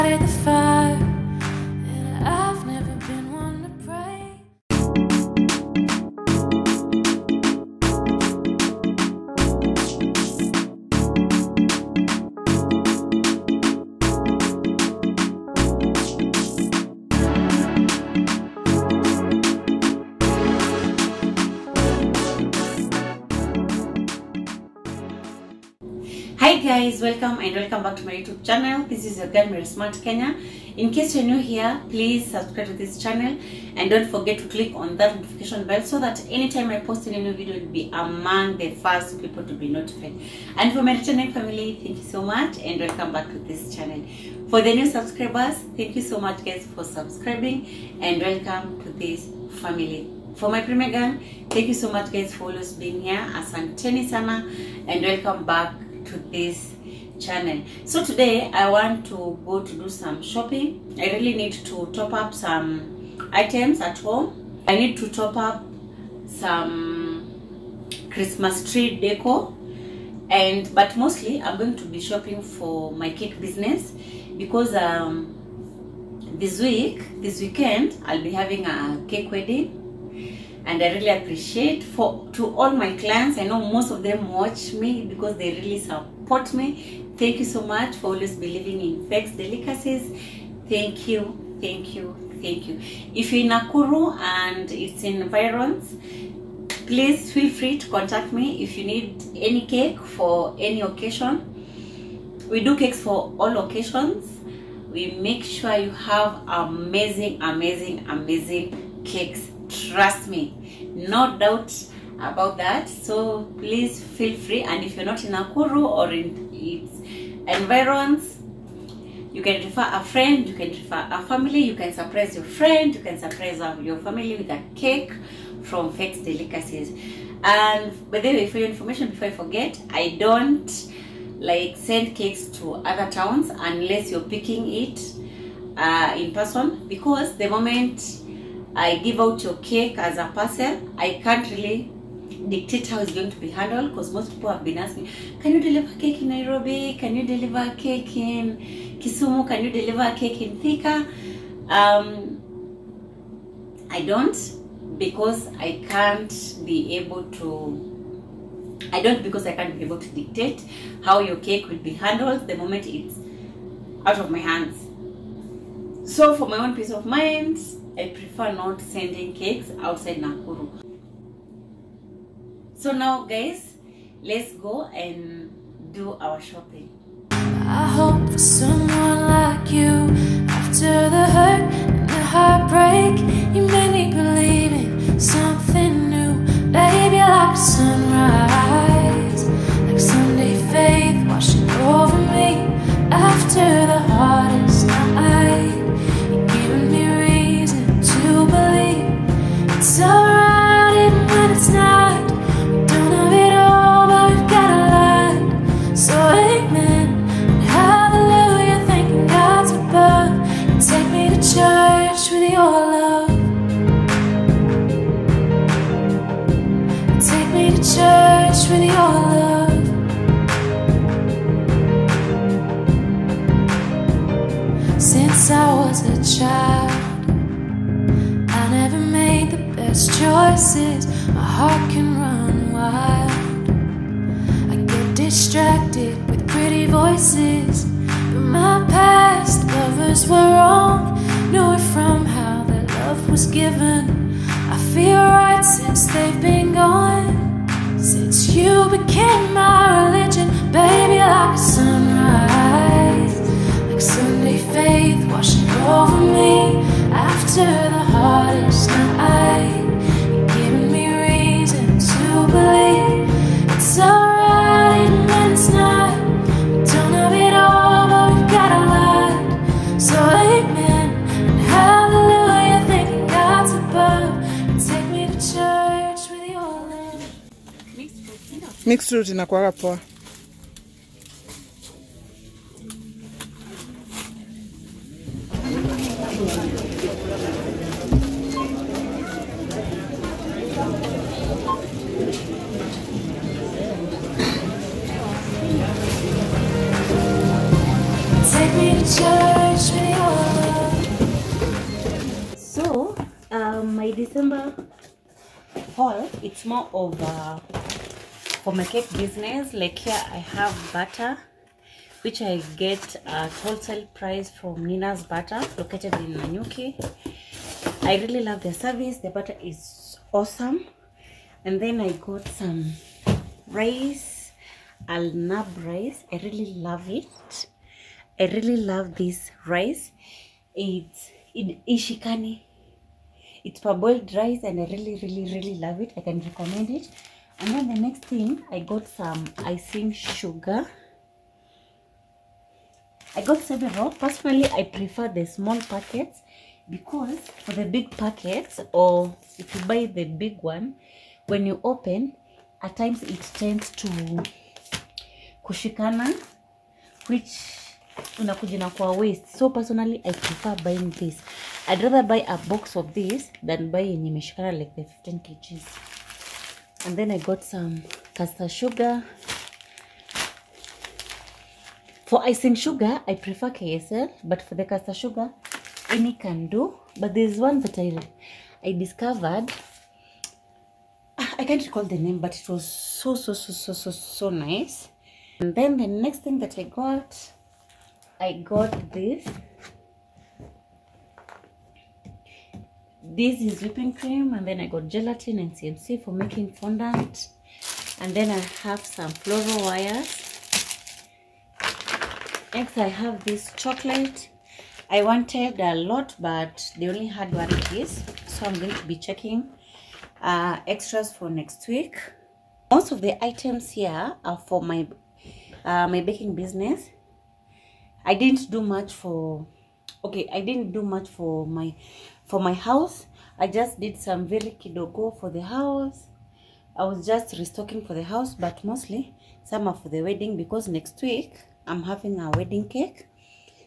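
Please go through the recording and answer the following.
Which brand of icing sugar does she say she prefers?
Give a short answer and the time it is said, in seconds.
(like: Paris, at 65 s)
KSL, at 373 s.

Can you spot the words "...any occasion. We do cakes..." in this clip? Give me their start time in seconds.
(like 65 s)
100 s.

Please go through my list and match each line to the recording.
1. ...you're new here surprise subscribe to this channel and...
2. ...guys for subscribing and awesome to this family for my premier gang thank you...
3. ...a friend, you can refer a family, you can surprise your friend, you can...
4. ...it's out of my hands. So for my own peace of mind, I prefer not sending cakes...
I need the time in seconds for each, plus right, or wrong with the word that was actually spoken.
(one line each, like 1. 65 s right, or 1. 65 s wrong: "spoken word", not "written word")
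1. 31 s wrong: "please", not "surprise"
2. 46 s wrong: "welcome", not "awesome"
3. 119 s right
4. 162 s right.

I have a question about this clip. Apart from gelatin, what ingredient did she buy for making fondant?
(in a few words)
CMC.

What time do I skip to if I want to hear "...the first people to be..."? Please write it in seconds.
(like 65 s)
38 s.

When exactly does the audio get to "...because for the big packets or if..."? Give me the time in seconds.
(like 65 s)
346 s.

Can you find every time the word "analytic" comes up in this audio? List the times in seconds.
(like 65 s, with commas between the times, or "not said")
not said.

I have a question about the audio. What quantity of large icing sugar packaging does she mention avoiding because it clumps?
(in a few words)
15 kgs.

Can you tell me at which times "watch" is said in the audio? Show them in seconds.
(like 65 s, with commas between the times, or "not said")
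84 s.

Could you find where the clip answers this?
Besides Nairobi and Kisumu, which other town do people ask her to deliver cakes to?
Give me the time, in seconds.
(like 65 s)
150 s.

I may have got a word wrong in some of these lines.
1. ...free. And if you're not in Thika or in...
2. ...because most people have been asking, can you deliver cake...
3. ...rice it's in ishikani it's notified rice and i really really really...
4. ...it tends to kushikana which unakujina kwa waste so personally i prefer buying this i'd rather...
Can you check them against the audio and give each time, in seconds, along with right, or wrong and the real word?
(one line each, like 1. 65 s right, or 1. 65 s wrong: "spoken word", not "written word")
1. 114 s wrong: "Nakuru", not "Thika"
2. 143 s right
3. 329 s wrong: "parboiled", not "notified"
4. 353 s right.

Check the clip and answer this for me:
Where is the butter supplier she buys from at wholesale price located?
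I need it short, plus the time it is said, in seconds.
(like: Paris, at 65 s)
Nanyuki, at 316 s.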